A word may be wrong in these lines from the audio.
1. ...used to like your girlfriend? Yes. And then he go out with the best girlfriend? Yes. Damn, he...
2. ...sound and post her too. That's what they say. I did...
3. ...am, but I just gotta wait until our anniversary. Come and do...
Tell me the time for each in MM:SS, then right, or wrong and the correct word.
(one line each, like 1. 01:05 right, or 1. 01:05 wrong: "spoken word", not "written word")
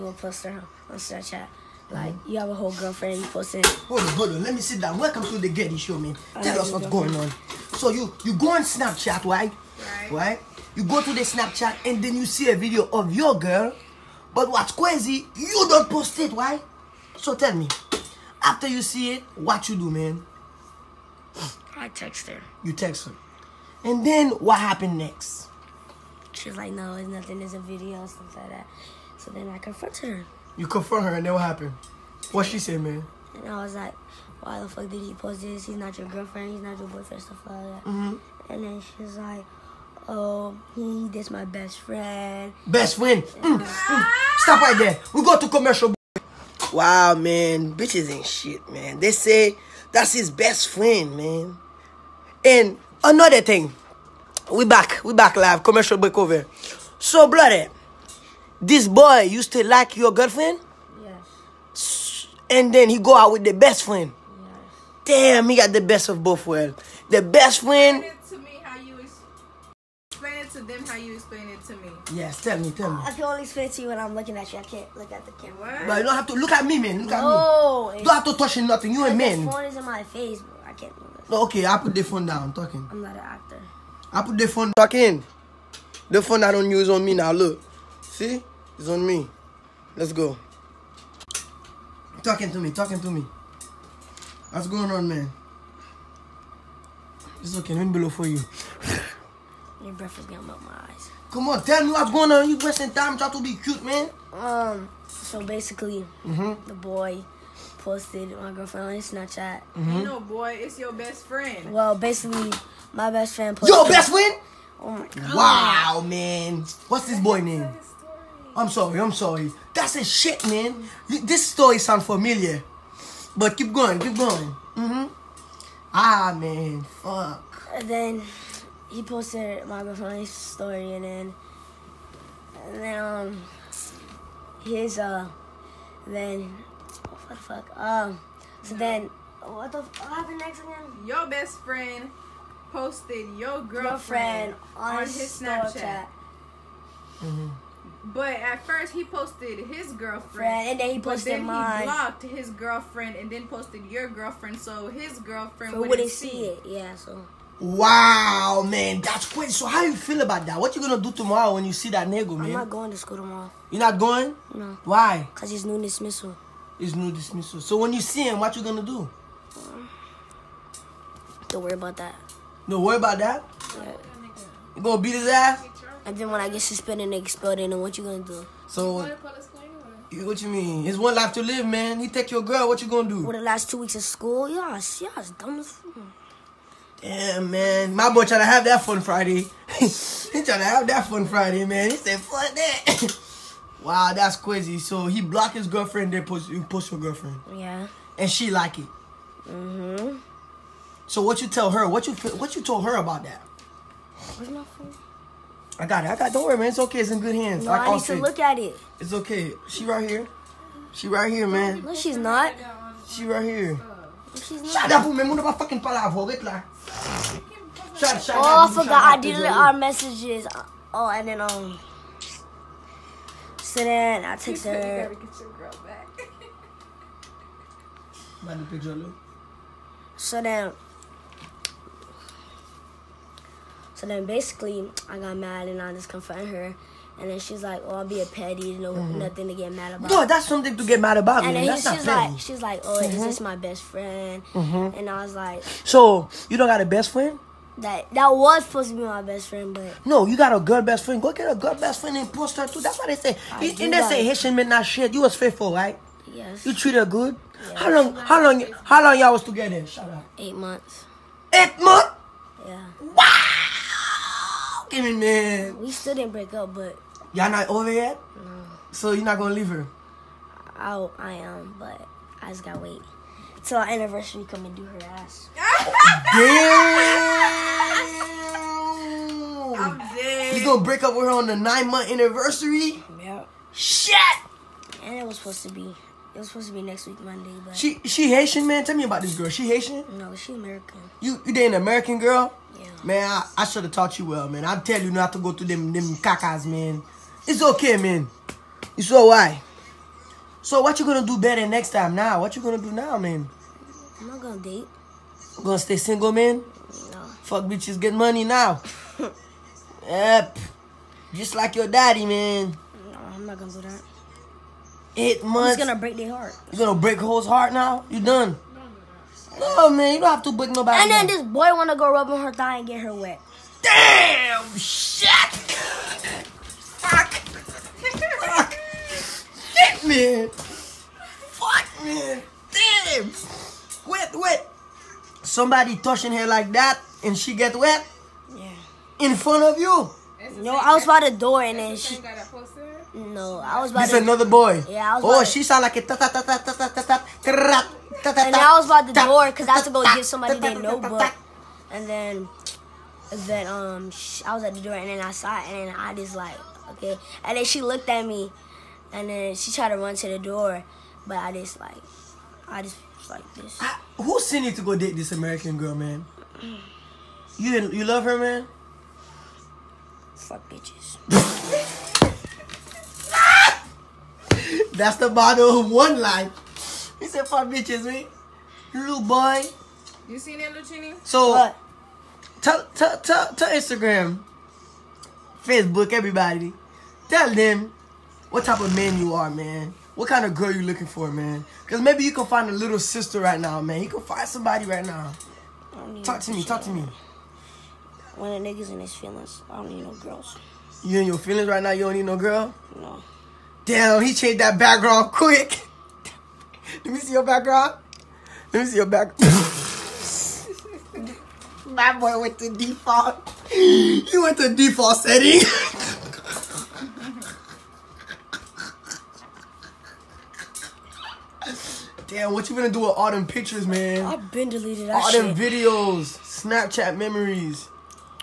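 1. 00:59 wrong: "friend", not "girlfriend"
2. 04:12 wrong: "friend", not "sound"
3. 04:31 right.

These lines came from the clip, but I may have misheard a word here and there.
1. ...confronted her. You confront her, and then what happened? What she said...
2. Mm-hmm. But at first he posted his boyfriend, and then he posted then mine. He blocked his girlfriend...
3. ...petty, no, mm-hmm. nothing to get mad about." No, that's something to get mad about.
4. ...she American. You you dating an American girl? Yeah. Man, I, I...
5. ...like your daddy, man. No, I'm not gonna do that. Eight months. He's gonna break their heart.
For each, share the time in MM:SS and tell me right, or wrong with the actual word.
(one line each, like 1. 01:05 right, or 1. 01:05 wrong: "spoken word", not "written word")
1. 00:29 right
2. 02:27 wrong: "girlfriend", not "boyfriend"
3. 03:58 right
4. 04:50 right
5. 05:11 right.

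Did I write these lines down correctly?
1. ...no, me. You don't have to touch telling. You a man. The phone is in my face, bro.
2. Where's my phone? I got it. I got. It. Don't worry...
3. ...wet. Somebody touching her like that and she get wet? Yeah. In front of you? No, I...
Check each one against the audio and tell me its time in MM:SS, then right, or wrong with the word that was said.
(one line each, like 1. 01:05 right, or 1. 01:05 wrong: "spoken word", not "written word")
1. 01:17 wrong: "nothing", not "telling"
2. 03:24 right
3. 05:34 right.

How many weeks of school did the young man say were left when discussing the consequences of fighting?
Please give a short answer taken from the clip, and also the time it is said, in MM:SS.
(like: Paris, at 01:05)
2, at 03:03.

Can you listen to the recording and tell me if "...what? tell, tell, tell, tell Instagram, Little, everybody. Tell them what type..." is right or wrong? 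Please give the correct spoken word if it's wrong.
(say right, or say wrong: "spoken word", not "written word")
wrong: "Facebook", not "Little".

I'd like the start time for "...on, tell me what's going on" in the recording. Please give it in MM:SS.
01:41.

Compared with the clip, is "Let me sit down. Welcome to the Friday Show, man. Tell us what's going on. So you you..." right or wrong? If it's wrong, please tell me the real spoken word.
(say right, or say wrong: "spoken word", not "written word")
wrong: "Gerdy", not "Friday".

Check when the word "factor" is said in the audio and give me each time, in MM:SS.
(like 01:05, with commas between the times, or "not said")
not said.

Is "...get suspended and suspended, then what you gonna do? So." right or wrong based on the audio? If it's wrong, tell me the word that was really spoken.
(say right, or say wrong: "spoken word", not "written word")
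wrong: "expelled", not "suspended".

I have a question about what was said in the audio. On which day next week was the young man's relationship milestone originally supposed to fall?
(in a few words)
Monday.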